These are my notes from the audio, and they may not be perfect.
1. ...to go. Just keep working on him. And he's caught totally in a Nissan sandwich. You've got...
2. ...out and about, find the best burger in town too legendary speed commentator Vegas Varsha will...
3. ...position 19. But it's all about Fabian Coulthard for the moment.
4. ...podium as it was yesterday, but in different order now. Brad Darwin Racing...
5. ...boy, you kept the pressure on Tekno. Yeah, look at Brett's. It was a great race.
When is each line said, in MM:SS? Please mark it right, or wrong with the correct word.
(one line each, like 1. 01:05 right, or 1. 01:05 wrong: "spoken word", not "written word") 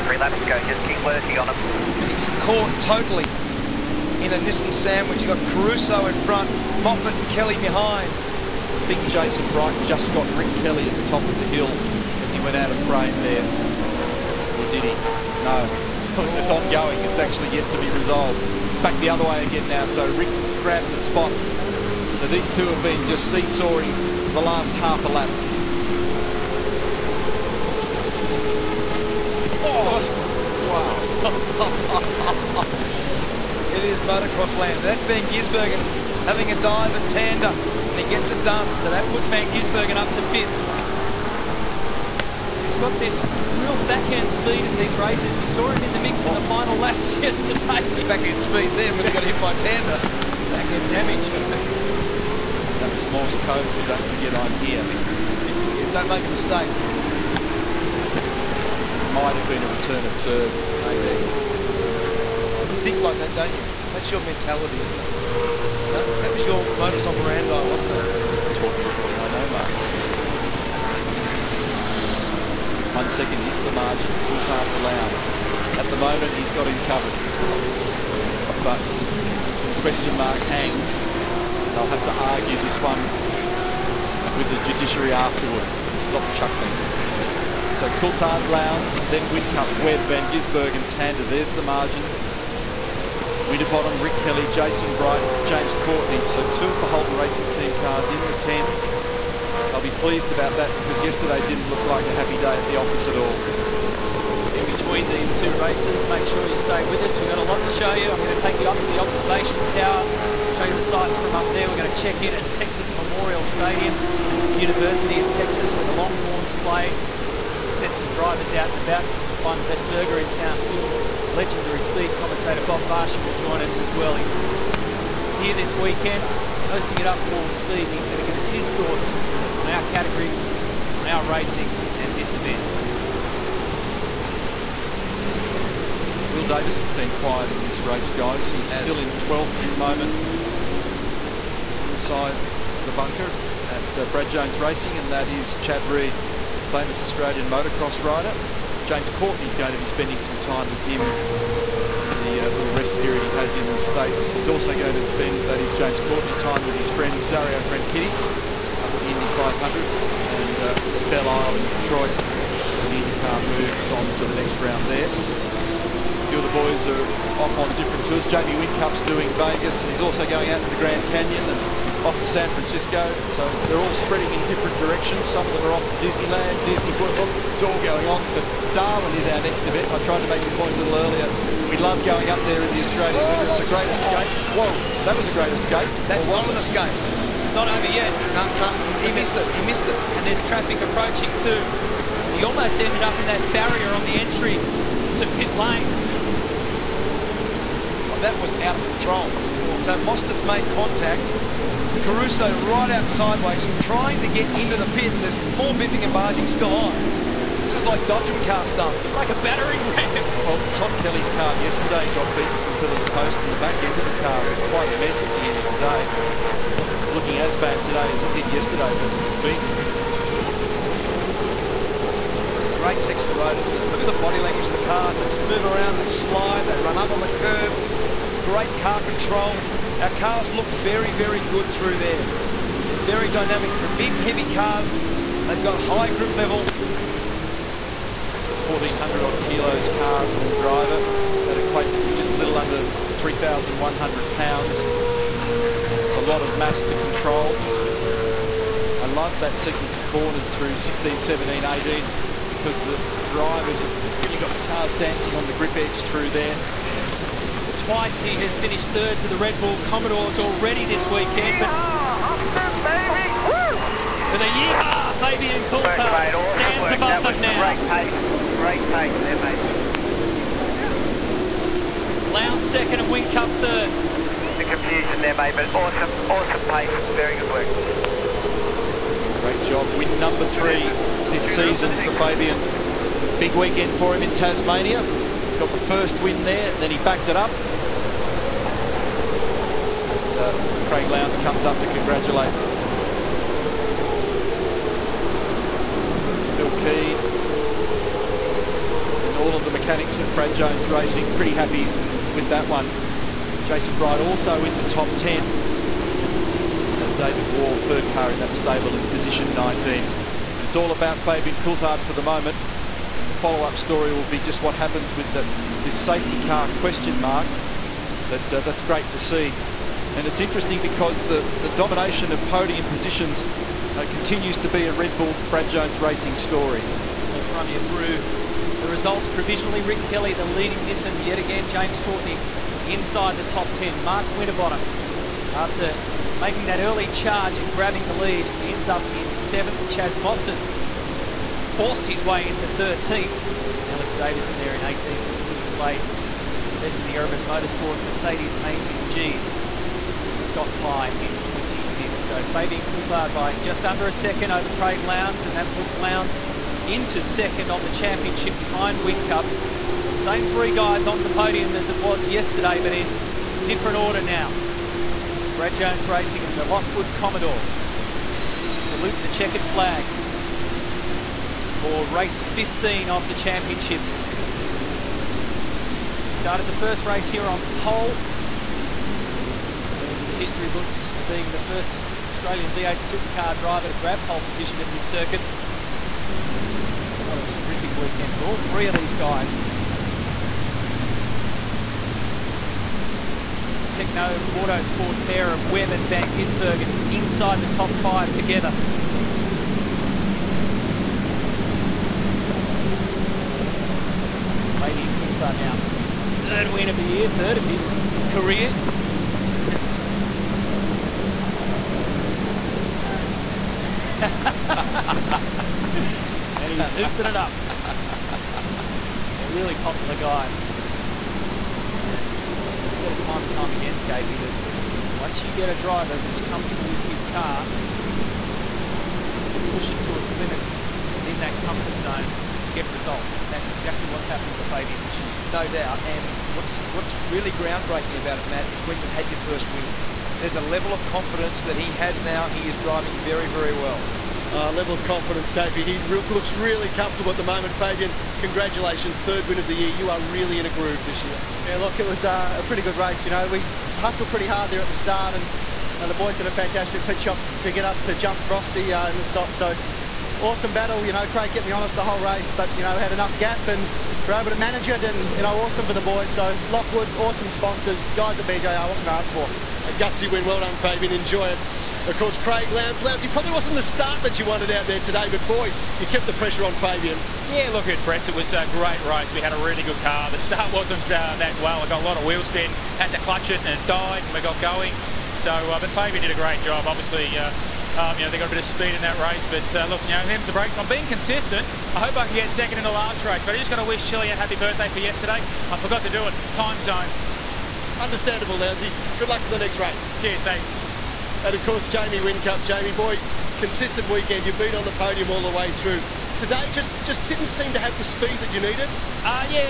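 1. 00:00 right
2. 01:58 wrong: "Bob", not "Vegas"
3. 05:09 right
4. 06:01 wrong: "Jones", not "Darwin"
5. 07:55 wrong: "Fabian", not "Tekno".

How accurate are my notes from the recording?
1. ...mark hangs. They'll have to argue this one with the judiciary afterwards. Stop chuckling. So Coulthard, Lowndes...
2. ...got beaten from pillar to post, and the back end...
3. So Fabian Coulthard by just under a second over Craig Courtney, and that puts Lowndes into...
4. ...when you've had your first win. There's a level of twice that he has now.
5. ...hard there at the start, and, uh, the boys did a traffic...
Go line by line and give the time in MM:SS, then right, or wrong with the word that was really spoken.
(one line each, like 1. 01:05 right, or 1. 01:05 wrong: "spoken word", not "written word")
1. 01:20 right
2. 03:32 right
3. 05:52 wrong: "Lowndes", not "Courtney"
4. 07:18 wrong: "confidence", not "twice"
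5. 07:34 wrong: "fantastic", not "traffic".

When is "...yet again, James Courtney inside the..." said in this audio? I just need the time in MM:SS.
05:31.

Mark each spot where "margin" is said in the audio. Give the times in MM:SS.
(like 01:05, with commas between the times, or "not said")
01:13, 01:31.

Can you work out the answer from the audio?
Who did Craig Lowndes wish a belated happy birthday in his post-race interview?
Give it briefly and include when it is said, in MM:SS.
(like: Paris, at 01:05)
Chile, at 08:14.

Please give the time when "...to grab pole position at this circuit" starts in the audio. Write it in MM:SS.
06:23.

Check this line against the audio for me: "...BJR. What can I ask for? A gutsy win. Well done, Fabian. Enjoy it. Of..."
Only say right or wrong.
right.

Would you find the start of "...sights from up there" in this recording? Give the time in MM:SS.
01:50.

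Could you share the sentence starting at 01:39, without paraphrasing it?
I'll be pleased about that because yesterday didn't look like a happy day at the office at all.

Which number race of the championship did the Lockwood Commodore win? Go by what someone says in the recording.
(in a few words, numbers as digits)
15.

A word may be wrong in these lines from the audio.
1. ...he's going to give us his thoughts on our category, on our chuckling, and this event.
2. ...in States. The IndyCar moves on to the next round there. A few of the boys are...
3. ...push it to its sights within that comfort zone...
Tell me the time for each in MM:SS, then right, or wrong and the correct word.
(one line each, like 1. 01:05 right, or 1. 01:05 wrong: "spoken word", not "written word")
1. 02:07 wrong: "racing", not "chuckling"
2. 02:41 wrong: "Detroit", not "States"
3. 07:09 wrong: "limits", not "sights".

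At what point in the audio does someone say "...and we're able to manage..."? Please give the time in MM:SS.
07:43.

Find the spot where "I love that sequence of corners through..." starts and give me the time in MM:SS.
04:08.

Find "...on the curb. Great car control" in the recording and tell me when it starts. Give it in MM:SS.
03:47.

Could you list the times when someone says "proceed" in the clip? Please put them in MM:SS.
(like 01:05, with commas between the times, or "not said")
not said.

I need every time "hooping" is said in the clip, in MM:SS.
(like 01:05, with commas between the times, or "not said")
06:56.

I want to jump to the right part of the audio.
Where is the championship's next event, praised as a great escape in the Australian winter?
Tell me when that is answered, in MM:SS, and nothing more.
02:58.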